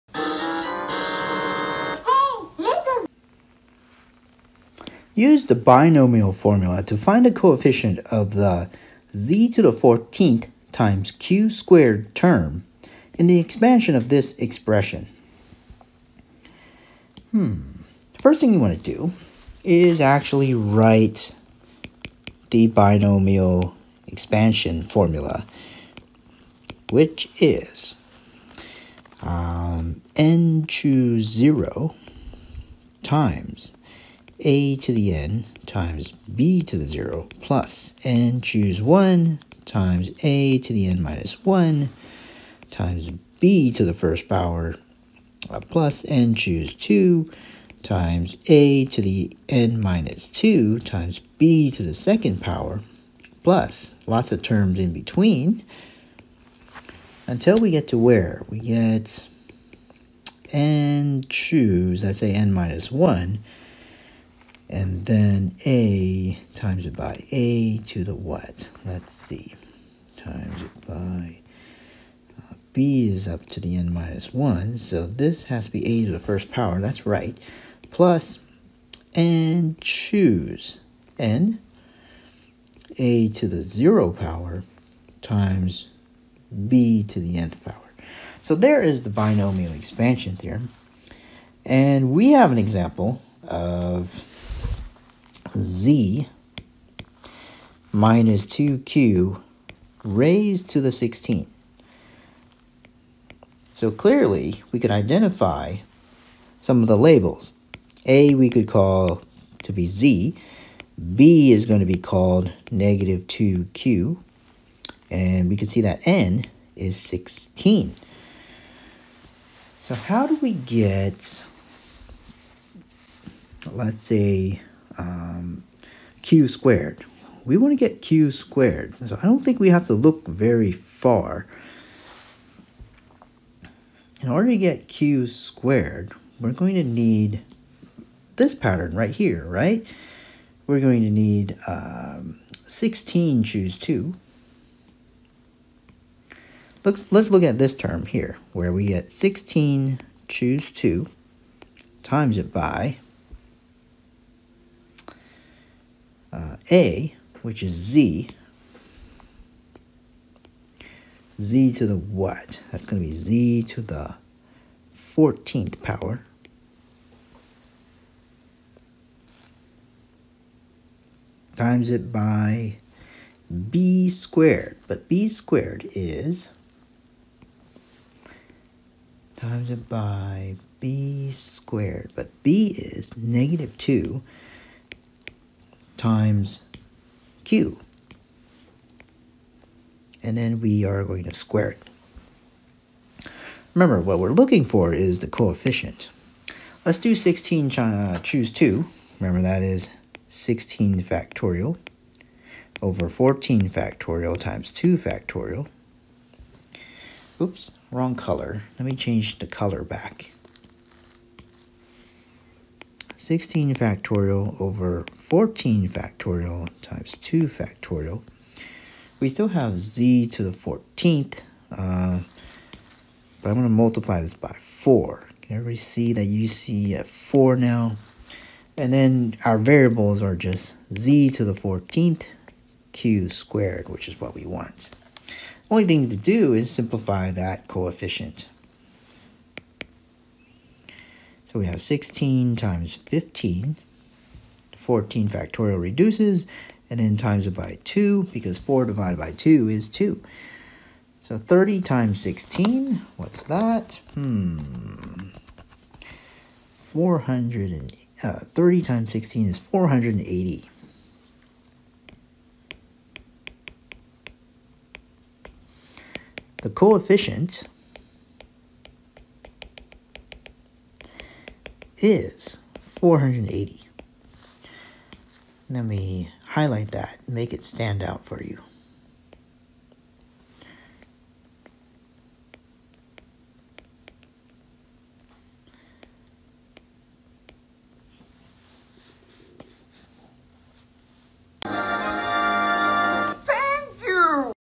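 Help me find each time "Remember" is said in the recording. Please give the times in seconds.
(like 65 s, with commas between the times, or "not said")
193 s, 199 s.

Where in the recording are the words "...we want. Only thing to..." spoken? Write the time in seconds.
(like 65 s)
234 s.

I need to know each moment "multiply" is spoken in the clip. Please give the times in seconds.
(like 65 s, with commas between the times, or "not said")
223 s.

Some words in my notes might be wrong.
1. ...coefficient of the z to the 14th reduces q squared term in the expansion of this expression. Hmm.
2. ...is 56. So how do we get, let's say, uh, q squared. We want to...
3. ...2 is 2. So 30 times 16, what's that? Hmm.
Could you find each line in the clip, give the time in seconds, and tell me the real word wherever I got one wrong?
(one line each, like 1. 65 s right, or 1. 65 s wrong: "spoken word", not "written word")
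1. 7 s wrong: "times", not "reduces"
2. 116 s wrong: "16", not "56"
3. 249 s right.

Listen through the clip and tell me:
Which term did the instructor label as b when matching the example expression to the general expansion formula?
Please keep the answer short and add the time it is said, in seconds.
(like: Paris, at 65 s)
negative 2q, at 112 s.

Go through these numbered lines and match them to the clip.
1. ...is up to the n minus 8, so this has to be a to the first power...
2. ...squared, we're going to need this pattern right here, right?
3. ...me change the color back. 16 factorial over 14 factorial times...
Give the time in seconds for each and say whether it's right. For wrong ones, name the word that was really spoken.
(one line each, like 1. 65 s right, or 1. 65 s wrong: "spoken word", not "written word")
1. 73 s wrong: "1", not "8"
2. 135 s right
3. 208 s right.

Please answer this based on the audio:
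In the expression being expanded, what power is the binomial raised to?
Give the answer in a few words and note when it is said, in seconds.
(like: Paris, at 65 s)
16, at 100 s.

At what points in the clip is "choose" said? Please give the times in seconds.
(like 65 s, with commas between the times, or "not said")
30 s, 38 s, 46 s, 61 s, 79 s, 143 s, 150 s, 198 s.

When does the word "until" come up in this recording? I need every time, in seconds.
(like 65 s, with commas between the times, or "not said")
57 s.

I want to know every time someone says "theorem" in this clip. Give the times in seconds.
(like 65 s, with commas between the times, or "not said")
90 s.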